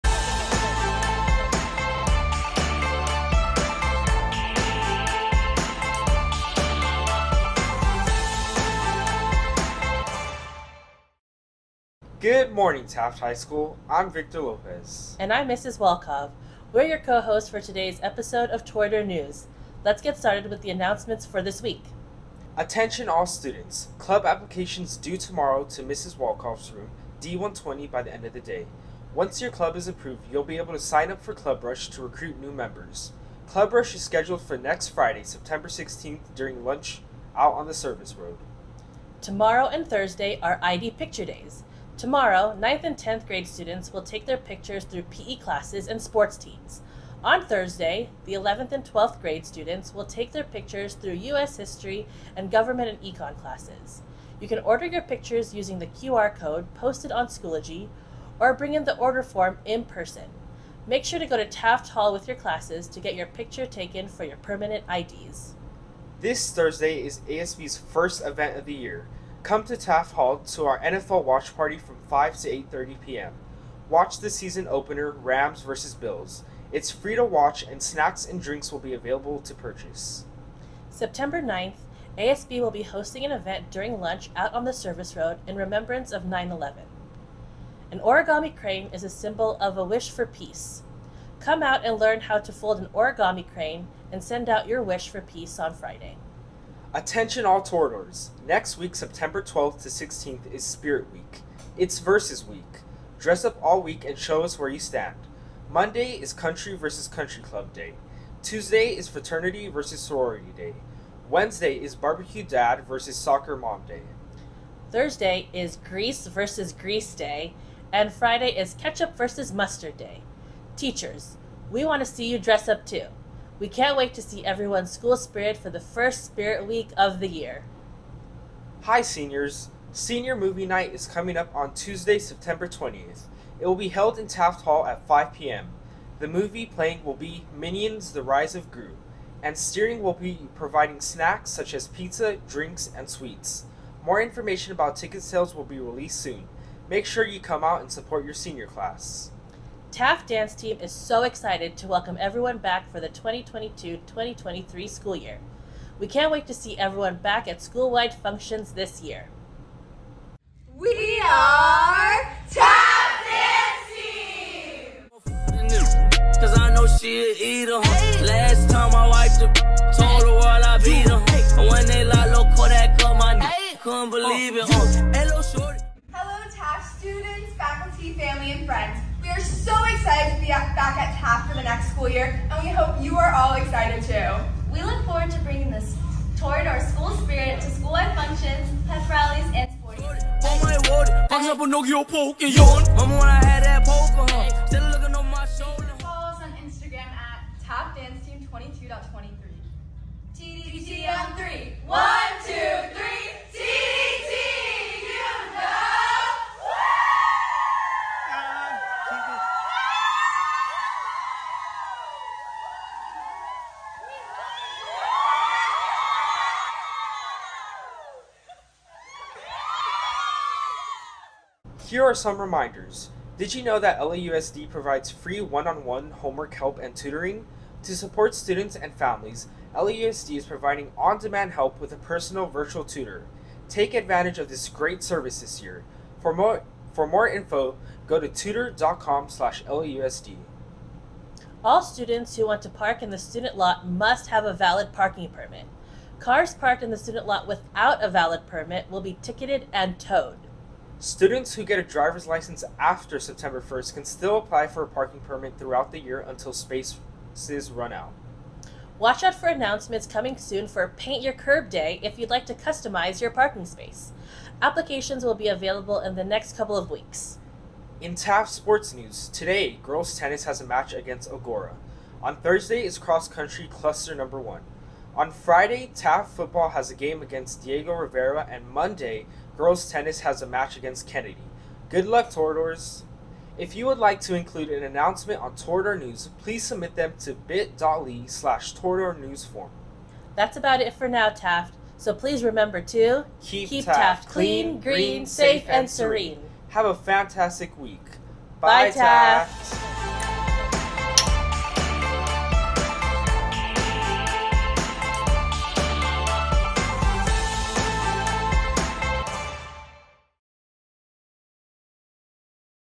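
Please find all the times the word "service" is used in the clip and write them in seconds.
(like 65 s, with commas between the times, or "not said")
37 s, 84 s, 235 s.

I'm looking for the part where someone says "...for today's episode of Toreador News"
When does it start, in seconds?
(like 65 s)
17 s.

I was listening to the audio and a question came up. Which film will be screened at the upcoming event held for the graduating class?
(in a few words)
Minions: The Rise of Gru.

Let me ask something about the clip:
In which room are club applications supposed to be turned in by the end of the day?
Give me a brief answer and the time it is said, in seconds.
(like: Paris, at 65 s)
D120, at 27 s.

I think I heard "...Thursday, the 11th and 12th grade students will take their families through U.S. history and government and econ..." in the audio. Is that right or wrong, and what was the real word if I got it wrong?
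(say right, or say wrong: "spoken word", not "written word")
wrong: "pictures", not "families".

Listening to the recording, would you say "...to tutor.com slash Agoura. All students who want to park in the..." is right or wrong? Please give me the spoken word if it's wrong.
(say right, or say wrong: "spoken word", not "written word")
wrong: "LAUSD", not "Agoura".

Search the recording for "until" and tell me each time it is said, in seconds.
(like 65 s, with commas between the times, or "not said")
256 s.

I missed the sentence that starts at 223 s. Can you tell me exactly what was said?
Did you know that LAUSD provides free one-on-one homework help and tutoring?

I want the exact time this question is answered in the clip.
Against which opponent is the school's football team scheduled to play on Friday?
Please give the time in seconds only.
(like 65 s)
277 s.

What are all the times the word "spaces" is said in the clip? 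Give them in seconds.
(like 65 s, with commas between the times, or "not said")
256 s, 263 s.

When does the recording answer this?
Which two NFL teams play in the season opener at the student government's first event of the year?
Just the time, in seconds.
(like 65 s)
75 s.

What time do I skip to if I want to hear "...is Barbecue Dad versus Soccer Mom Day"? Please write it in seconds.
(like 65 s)
111 s.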